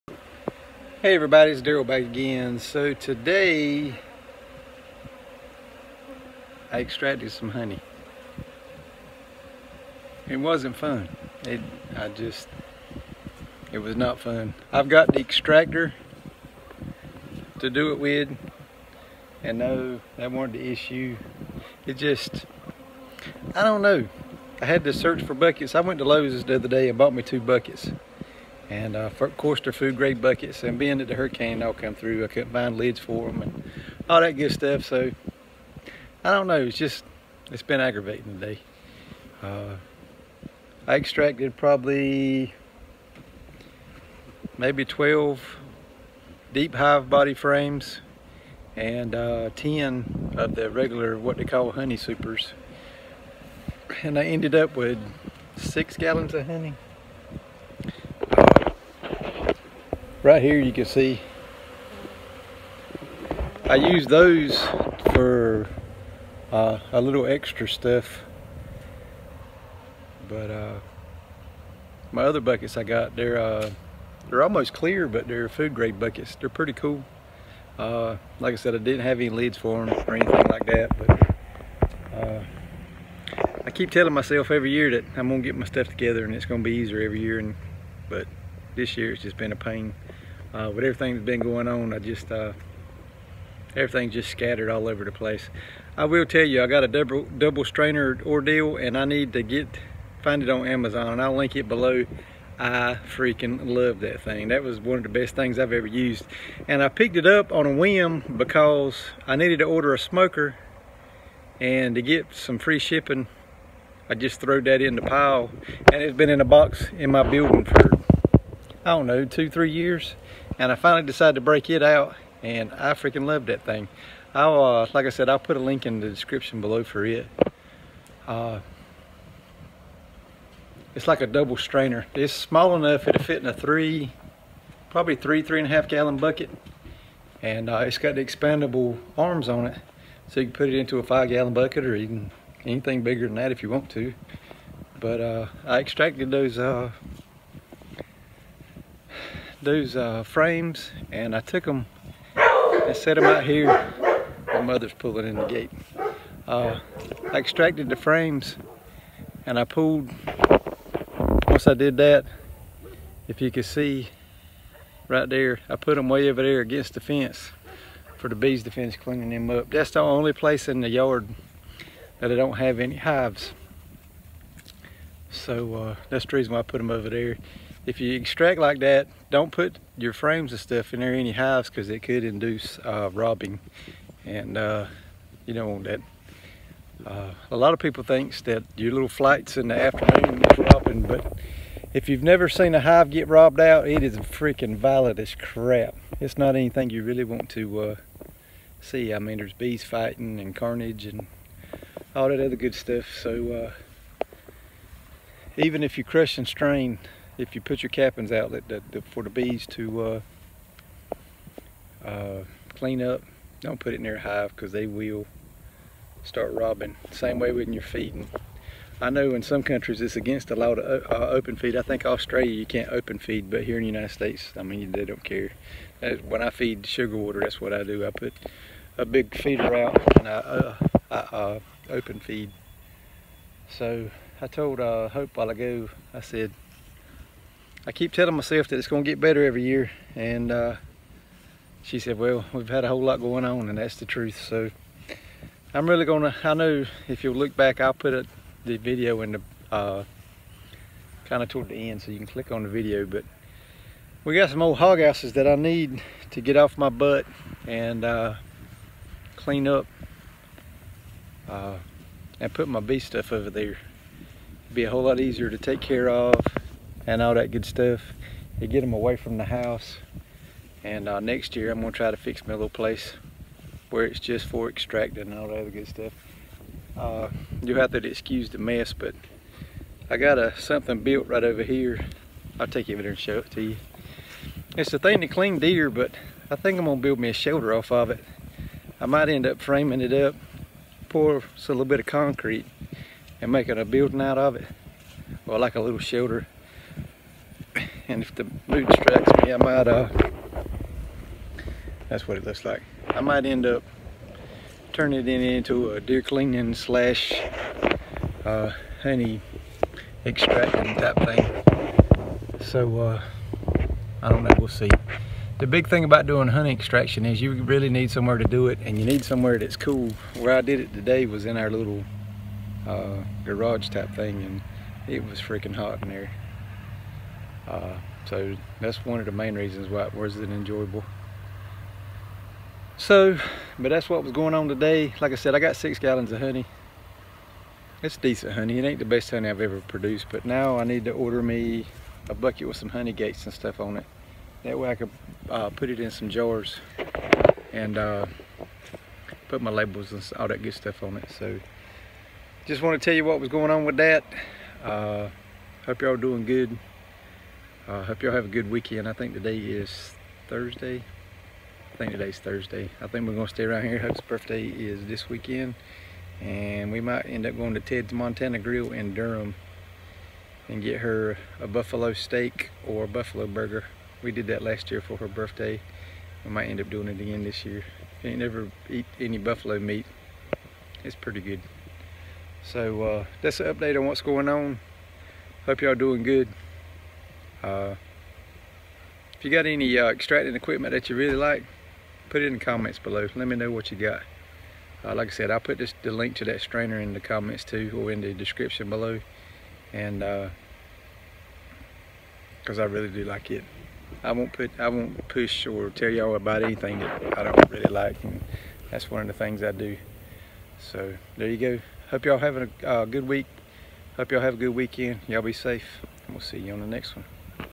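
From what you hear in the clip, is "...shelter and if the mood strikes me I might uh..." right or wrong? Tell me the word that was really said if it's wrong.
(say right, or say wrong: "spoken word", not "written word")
right.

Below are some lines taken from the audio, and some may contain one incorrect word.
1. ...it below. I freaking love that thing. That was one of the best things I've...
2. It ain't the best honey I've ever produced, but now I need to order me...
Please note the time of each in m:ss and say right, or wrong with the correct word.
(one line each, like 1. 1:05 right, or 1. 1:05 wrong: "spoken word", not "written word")
1. 1:41 right
2. 5:38 right.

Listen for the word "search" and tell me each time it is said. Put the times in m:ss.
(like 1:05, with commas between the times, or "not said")
0:24.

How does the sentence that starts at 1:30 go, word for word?
Uh, with everything that's been going on, I just, uh, everything's just scattered all over the place.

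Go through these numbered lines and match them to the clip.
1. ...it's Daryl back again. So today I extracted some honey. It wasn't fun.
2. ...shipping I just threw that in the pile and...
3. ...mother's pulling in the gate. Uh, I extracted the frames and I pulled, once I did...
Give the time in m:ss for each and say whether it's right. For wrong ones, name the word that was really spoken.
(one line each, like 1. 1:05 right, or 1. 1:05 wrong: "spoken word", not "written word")
1. 0:01 right
2. 1:52 right
3. 2:34 right.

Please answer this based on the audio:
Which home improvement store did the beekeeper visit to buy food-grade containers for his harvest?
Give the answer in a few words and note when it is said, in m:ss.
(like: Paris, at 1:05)
Lowe's, at 0:26.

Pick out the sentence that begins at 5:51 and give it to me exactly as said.
So just want to tell you what was going on with that.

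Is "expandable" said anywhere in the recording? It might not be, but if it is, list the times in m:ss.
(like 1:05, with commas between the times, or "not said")
2:18.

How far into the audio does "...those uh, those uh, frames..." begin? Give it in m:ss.
2:26.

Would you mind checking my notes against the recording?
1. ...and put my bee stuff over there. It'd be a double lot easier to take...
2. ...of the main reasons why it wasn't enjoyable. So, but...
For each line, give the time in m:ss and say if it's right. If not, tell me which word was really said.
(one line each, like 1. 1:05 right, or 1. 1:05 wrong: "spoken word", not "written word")
1. 4:22 wrong: "whole", not "double"
2. 5:29 right.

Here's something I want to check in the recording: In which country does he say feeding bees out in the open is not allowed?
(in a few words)
Australia.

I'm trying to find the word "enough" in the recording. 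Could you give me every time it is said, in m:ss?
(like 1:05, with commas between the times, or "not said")
2:12.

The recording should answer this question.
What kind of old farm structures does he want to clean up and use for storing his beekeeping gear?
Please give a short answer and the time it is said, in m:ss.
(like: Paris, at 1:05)
hog houses, at 4:14.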